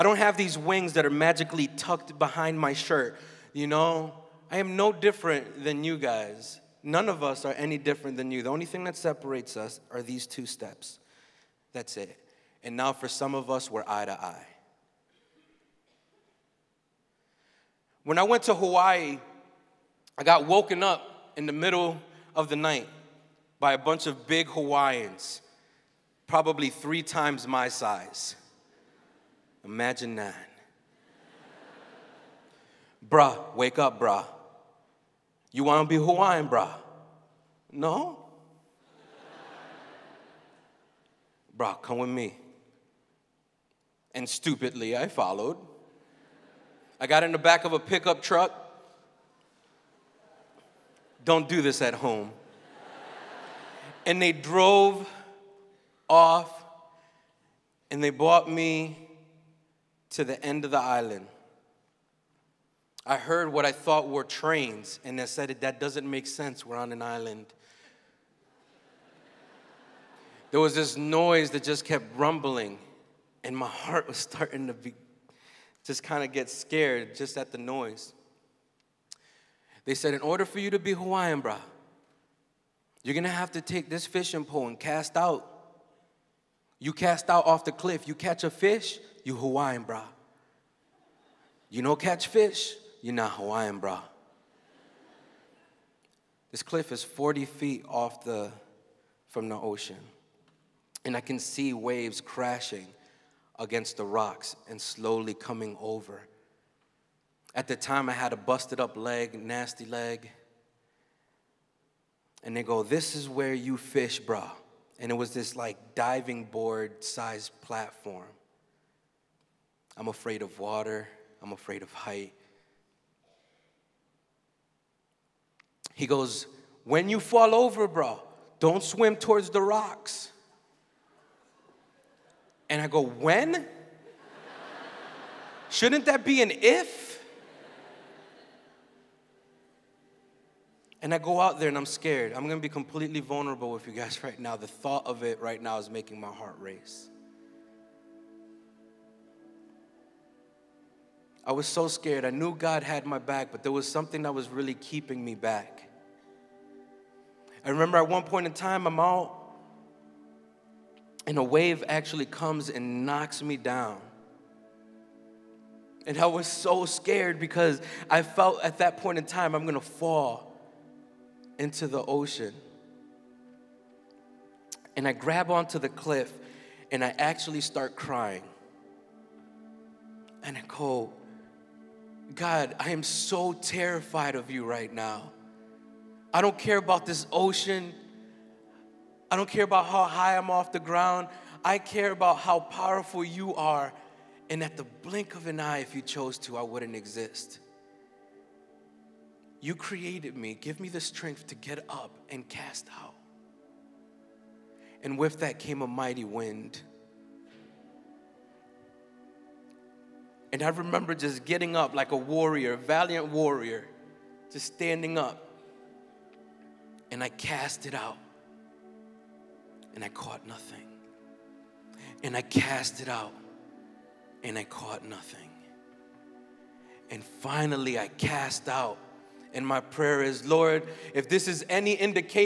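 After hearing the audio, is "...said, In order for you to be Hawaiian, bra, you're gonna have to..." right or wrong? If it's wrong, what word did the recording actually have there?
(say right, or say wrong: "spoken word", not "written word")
right.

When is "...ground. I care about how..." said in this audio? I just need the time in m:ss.
3:10.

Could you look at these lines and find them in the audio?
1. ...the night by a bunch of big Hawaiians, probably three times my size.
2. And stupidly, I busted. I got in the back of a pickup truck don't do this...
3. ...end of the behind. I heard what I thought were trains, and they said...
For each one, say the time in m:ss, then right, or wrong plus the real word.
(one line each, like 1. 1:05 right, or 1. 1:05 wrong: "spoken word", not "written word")
1. 0:22 right
2. 0:44 wrong: "followed", not "busted"
3. 1:00 wrong: "island", not "behind".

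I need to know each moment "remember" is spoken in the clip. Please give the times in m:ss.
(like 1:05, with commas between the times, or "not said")
2:37, 3:30.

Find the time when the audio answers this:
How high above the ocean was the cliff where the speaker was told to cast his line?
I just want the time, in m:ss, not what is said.
1:37.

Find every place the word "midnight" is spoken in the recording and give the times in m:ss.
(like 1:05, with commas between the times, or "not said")
not said.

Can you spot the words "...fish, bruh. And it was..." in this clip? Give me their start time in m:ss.
1:53.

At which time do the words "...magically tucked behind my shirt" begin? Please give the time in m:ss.
0:01.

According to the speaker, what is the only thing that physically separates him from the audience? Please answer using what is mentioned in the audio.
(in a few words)
two steps.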